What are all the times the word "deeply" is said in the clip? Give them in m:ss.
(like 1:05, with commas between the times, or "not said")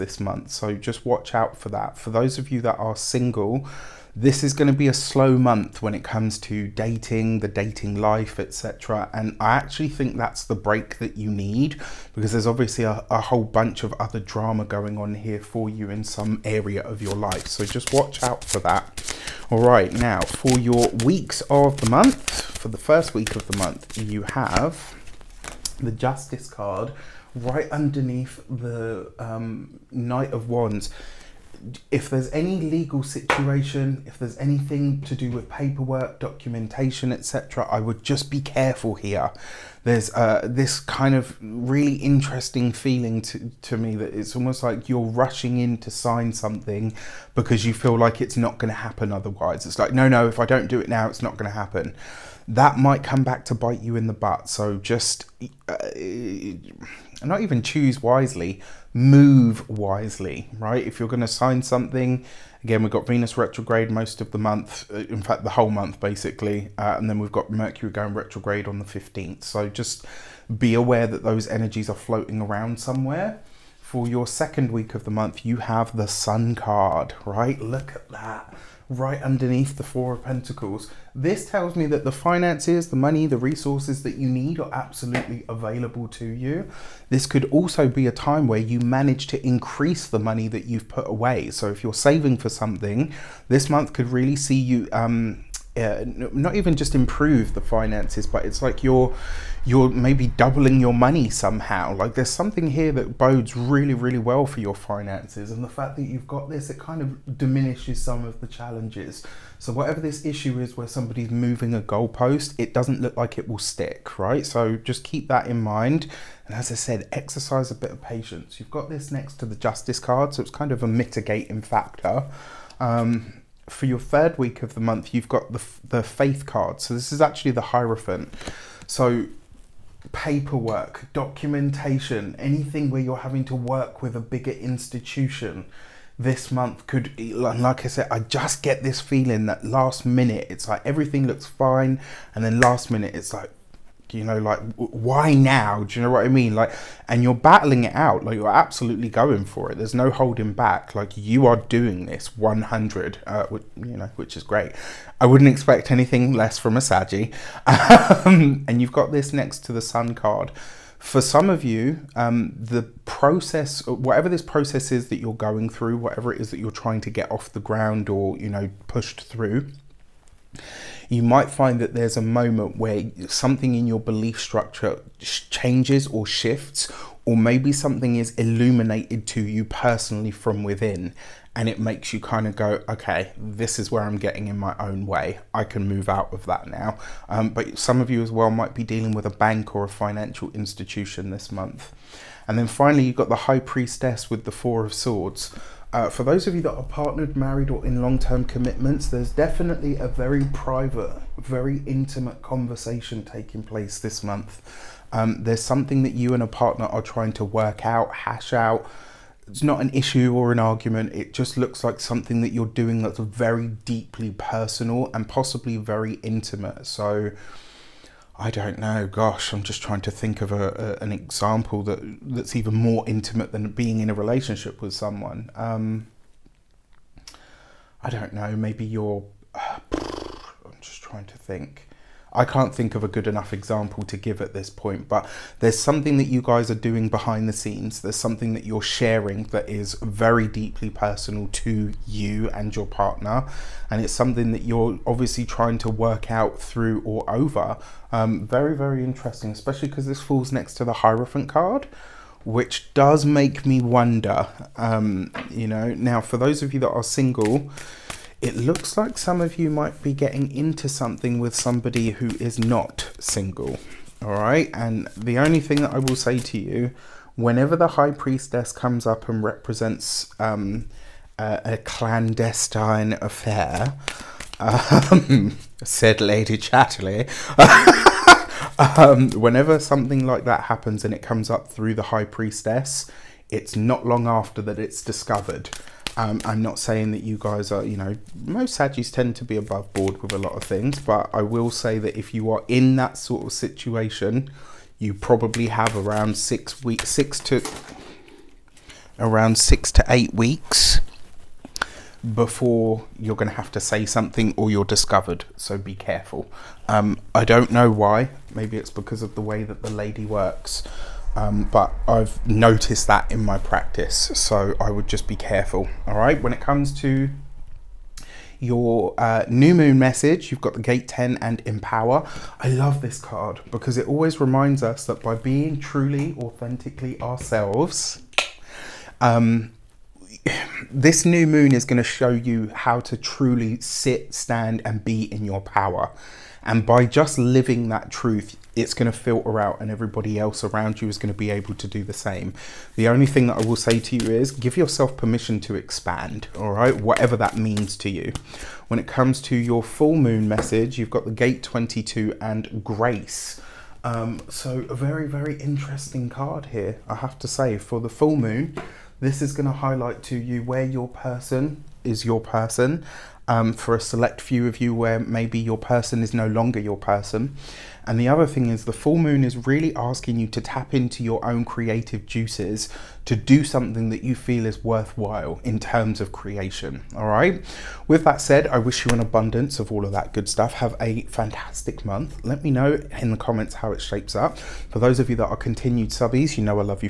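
3:33, 4:00.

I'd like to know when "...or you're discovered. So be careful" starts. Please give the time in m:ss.
5:04.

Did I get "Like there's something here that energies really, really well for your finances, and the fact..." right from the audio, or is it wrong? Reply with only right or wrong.
wrong.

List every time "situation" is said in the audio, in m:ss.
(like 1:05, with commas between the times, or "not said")
0:33, 4:53.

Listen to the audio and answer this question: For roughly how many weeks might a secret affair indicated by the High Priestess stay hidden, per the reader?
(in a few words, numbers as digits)
6 to 8 weeks.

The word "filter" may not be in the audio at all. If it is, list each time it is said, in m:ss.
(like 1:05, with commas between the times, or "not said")
5:39.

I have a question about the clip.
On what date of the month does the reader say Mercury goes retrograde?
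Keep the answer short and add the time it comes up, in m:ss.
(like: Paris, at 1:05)
15th, at 1:08.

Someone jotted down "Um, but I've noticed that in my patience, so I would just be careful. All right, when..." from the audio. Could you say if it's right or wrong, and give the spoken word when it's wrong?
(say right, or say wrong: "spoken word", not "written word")
wrong: "practice", not "patience".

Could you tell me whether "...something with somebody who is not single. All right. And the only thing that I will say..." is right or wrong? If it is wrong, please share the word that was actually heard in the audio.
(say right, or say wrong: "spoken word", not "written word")
right.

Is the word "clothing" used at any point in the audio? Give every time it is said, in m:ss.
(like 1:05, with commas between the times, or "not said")
not said.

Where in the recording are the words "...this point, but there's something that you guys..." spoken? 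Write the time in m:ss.
3:54.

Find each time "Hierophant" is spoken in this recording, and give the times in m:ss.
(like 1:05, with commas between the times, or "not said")
2:07, 4:10.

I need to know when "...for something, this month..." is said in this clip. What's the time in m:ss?
1:32.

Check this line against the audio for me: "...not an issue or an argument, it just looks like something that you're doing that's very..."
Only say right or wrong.
right.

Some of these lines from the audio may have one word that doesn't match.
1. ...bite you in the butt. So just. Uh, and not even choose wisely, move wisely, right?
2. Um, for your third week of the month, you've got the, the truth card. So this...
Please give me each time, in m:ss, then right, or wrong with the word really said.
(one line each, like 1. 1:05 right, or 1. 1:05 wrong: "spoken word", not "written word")
1. 0:53 right
2. 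2:02 wrong: "faith", not "truth".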